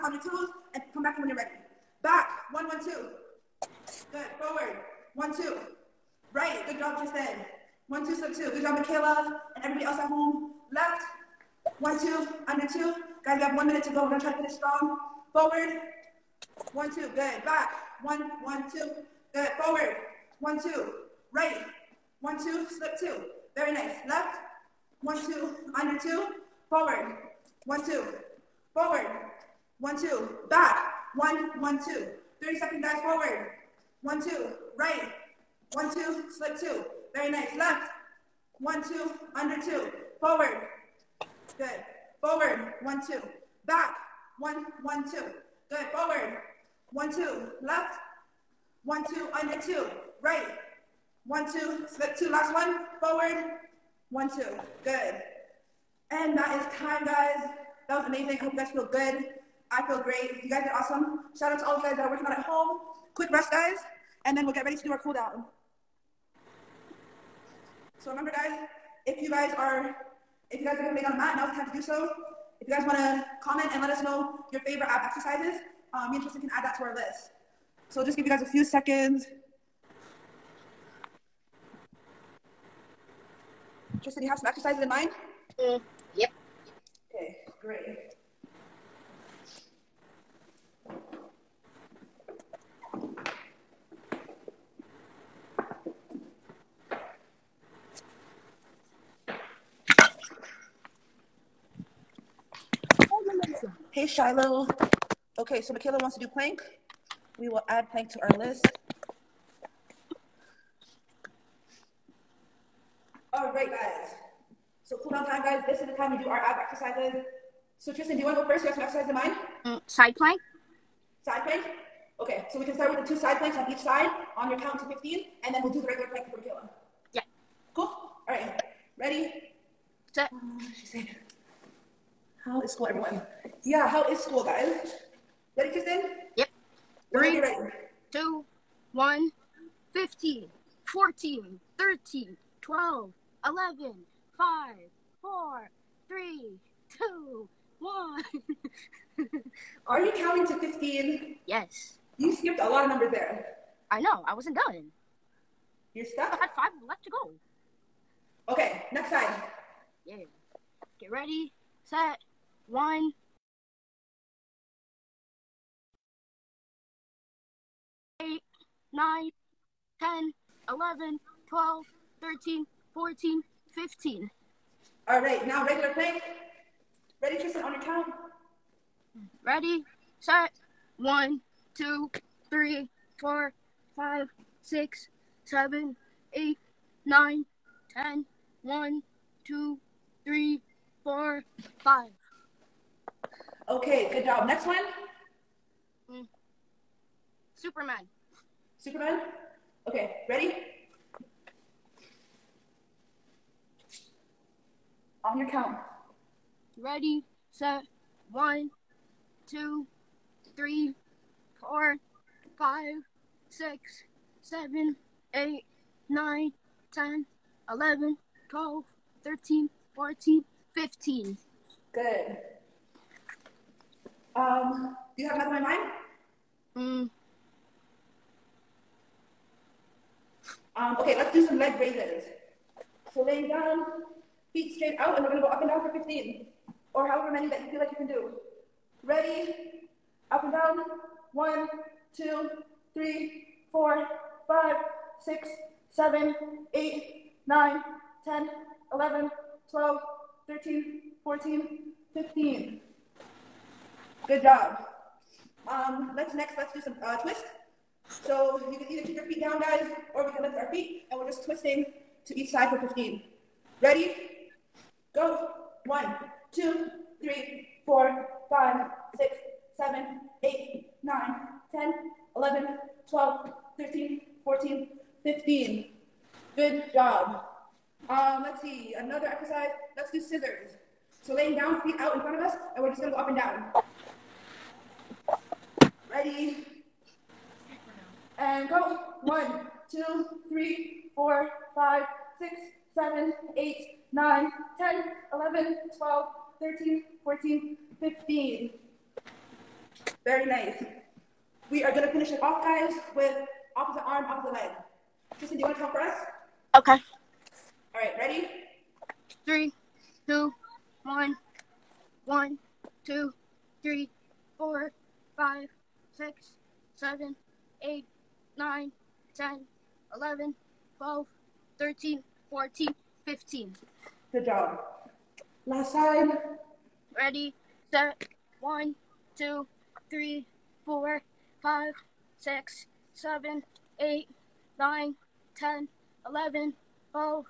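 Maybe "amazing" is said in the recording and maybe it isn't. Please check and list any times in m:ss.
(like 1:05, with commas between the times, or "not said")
0:58.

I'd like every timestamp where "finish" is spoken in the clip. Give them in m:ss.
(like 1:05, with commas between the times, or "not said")
0:14, 5:02.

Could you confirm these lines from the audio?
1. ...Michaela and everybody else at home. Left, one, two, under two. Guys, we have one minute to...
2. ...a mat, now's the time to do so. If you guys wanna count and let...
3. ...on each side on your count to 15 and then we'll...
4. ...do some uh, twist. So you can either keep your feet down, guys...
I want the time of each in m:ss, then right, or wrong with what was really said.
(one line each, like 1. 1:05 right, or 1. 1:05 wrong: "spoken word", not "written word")
1. 0:08 right
2. 1:11 wrong: "comment", not "count"
3. 2:03 right
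4. 4:16 right.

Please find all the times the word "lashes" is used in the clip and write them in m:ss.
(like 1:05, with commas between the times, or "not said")
not said.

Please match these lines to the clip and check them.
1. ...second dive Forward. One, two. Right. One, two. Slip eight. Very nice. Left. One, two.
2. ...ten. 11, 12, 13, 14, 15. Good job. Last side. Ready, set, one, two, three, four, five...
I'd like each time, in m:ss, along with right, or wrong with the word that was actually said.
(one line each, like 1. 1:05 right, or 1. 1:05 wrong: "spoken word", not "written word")
1. 0:32 wrong: "two", not "eight"
2. 5:19 right.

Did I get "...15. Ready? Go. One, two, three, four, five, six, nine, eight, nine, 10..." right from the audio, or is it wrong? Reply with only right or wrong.
wrong.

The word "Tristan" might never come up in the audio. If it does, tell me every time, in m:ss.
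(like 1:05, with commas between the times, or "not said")
0:06, 1:16, 1:24, 1:57, 2:15, 2:57, 5:05.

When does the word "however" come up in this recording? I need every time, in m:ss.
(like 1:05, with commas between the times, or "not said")
3:57.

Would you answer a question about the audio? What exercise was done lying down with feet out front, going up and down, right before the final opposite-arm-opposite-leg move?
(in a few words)
Scissors.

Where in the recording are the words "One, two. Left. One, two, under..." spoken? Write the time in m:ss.
0:46.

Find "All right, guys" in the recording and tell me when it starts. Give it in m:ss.
1:53.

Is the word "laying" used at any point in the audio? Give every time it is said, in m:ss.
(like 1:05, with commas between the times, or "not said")
3:53, 4:41.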